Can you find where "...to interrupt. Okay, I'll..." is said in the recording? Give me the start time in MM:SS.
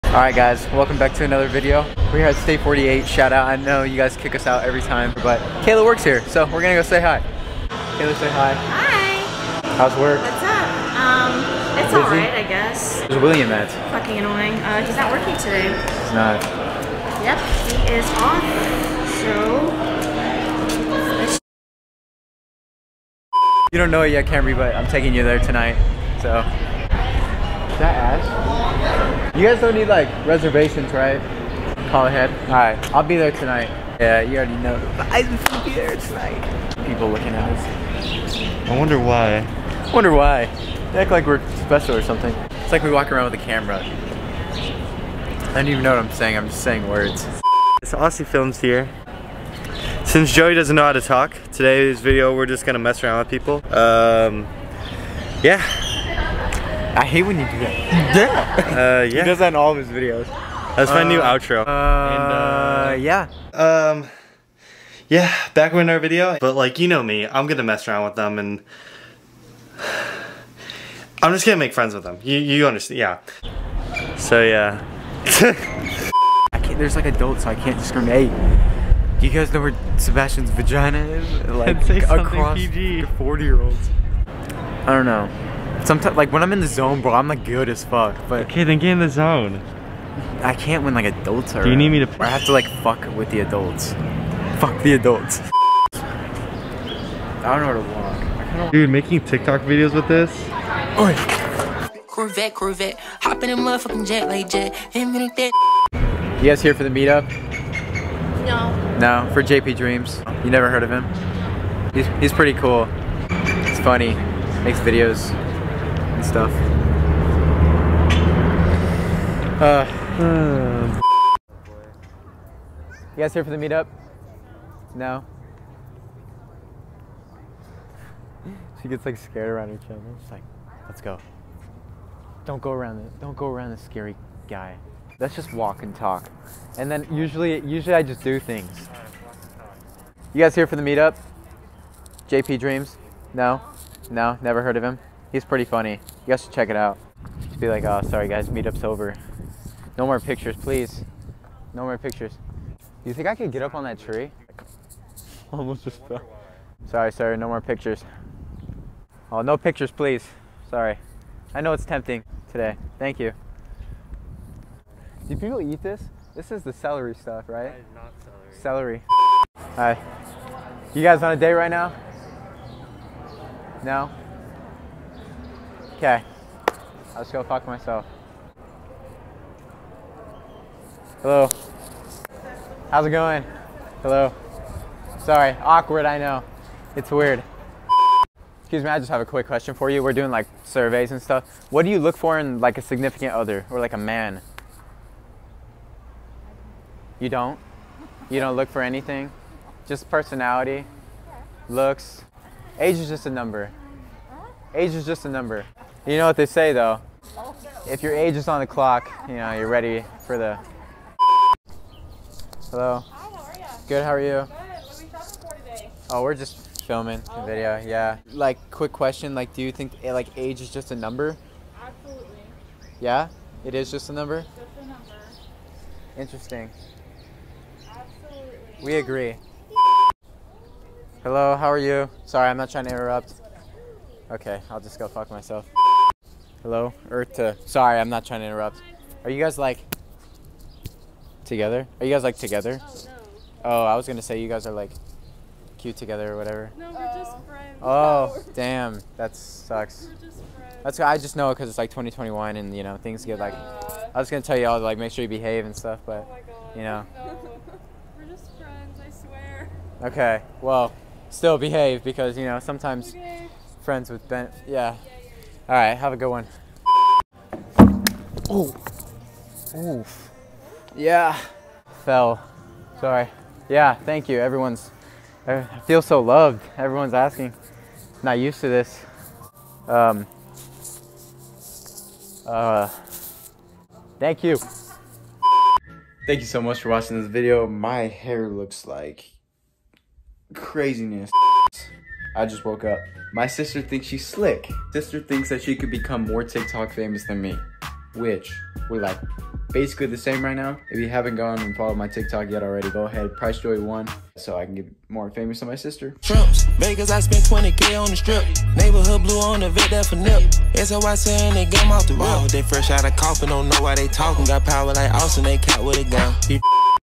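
03:52.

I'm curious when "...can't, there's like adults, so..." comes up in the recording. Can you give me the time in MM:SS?
01:16.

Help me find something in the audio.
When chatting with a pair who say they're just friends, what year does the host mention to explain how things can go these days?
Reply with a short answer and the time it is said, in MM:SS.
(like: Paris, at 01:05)
2021, at 04:11.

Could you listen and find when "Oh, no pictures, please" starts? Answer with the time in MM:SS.
02:39.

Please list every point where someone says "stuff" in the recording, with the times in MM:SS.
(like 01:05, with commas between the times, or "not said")
01:56, 02:47, 03:11, 04:15.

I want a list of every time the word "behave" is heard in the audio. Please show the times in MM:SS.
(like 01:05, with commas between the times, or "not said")
04:15, 04:21.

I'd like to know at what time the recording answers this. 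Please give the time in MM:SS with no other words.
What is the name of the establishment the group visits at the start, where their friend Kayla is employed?
00:02.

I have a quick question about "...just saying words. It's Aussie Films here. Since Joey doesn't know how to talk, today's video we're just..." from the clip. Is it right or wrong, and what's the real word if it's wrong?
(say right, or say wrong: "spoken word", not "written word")
right.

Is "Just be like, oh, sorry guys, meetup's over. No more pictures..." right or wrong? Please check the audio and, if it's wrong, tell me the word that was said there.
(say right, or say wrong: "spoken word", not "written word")
right.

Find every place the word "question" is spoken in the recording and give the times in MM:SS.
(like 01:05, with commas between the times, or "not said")
03:09, 03:38.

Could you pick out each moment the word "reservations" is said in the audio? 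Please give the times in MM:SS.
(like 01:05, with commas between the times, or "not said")
00:30.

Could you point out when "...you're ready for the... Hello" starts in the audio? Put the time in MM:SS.
03:29.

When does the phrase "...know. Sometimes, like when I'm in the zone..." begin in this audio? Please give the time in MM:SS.
01:25.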